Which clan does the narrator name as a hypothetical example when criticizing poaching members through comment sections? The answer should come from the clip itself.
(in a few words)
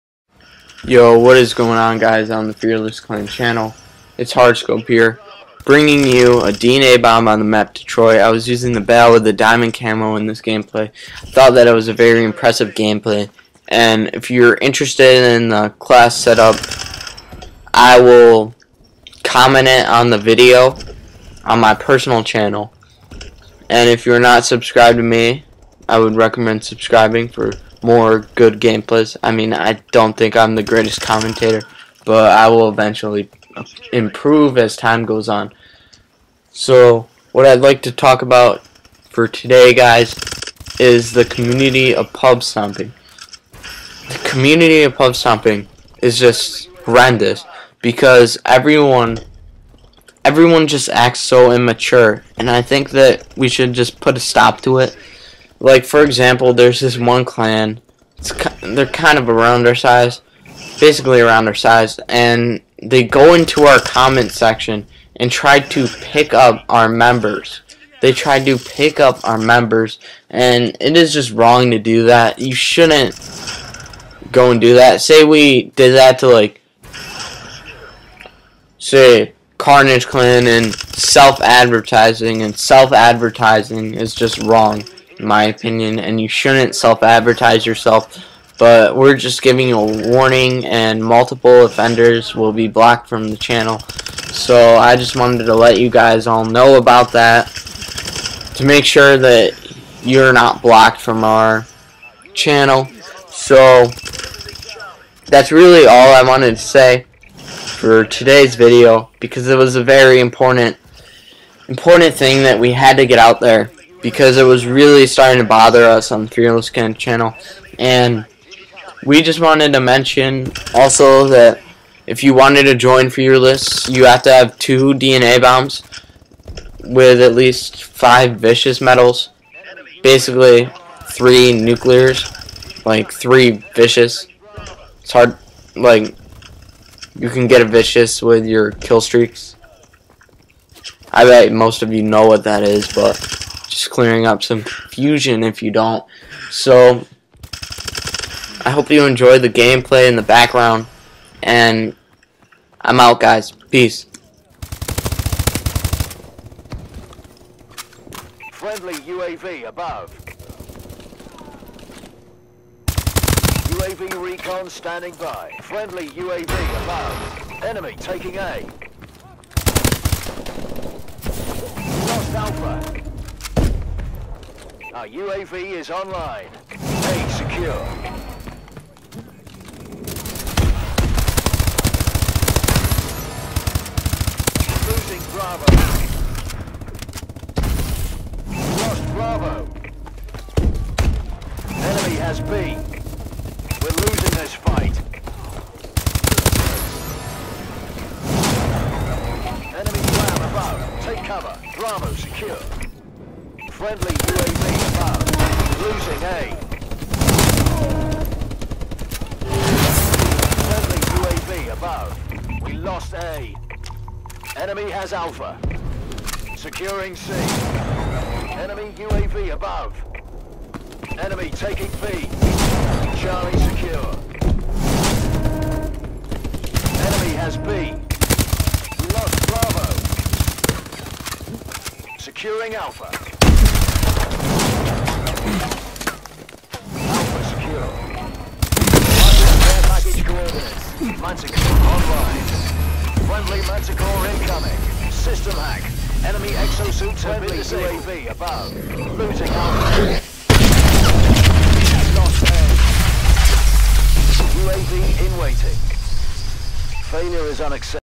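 Carnage Clan.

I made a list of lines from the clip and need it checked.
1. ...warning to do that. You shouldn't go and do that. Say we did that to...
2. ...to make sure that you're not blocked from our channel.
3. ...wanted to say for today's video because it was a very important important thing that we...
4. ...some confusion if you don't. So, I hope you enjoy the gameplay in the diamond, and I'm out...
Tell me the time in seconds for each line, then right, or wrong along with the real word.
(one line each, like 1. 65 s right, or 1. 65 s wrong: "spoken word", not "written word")
1. 71 s wrong: "wrong", not "warning"
2. 98 s right
3. 106 s right
4. 144 s wrong: "background", not "diamond".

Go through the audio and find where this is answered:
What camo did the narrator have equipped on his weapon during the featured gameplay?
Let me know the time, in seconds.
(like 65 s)
9 s.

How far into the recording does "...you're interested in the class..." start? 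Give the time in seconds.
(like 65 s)
14 s.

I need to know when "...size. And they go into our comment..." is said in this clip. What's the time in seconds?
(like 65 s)
61 s.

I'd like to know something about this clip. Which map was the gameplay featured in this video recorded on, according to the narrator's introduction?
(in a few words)
Detroit.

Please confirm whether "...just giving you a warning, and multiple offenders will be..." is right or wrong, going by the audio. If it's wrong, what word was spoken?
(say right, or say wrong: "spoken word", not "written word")
right.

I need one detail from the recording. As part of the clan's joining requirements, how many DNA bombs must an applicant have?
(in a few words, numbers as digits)
2.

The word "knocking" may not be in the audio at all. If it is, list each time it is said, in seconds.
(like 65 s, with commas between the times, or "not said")
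not said.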